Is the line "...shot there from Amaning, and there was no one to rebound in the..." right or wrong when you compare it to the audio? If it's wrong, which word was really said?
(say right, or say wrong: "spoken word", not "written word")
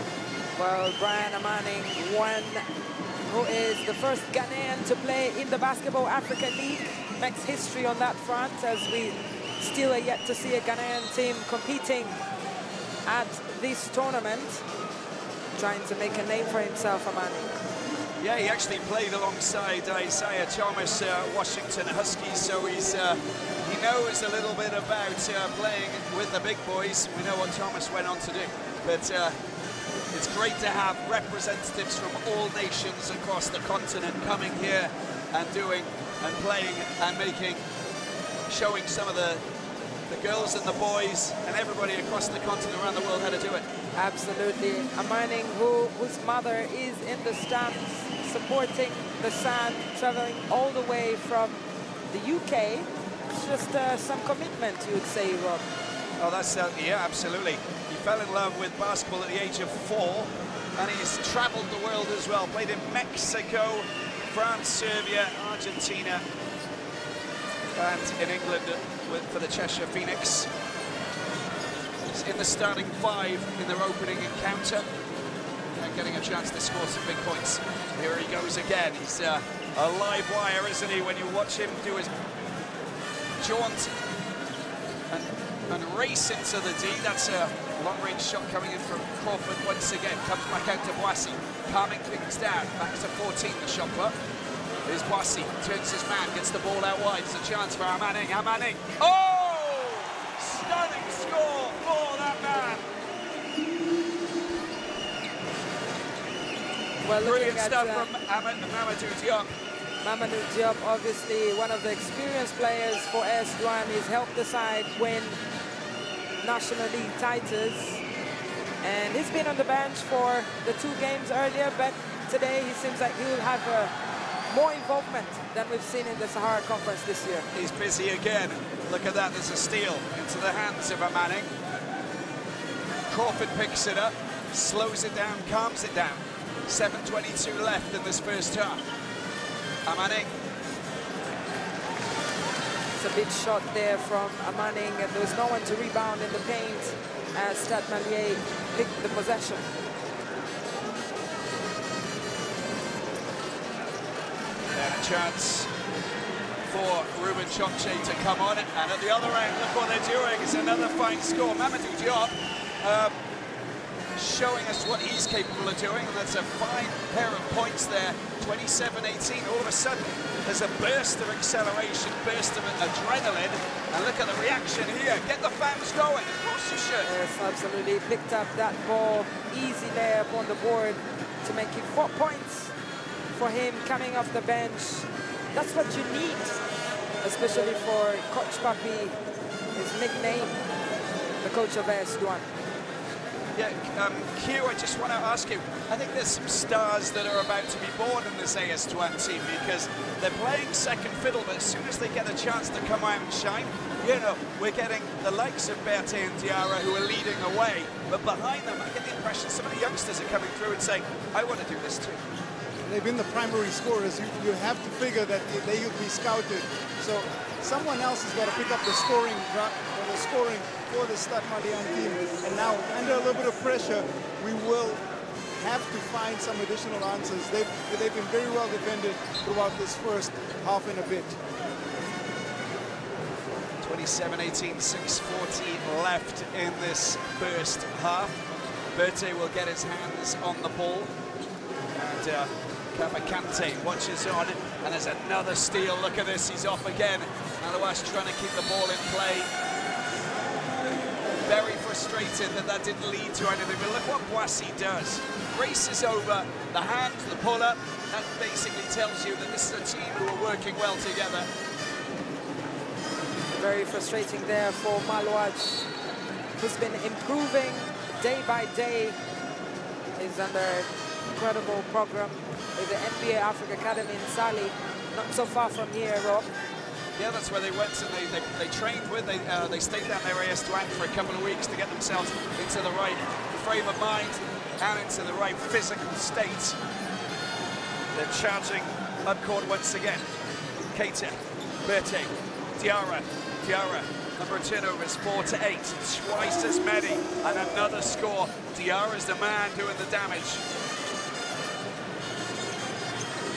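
right.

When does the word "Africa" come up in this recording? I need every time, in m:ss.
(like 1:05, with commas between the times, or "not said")
0:06, 4:33.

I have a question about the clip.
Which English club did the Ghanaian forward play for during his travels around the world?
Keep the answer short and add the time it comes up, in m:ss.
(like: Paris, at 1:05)
Cheshire Phoenix, at 1:09.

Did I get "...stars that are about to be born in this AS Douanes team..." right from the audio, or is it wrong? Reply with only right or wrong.
right.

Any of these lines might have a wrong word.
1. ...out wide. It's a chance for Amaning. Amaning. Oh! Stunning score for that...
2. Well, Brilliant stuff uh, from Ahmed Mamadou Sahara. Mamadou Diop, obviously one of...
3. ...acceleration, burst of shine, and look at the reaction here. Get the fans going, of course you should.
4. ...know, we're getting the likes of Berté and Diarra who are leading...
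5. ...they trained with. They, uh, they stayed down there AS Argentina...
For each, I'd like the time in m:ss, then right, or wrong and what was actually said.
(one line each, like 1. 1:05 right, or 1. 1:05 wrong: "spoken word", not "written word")
1. 1:36 right
2. 1:47 wrong: "Diop", not "Sahara"
3. 2:51 wrong: "adrenaline", not "shine"
4. 3:24 right
5. 4:38 wrong: "Douanes", not "Argentina".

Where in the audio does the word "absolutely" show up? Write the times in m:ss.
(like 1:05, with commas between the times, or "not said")
0:43, 0:57, 2:57.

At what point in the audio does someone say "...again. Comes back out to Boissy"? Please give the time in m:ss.
1:29.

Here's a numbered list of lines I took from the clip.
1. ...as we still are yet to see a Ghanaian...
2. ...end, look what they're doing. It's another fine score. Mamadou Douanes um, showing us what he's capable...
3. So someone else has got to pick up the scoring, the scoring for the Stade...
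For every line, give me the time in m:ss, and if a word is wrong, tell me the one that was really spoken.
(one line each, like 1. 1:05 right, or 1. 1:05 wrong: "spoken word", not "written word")
1. 0:08 right
2. 2:39 wrong: "Diop", not "Douanes"
3. 3:37 right.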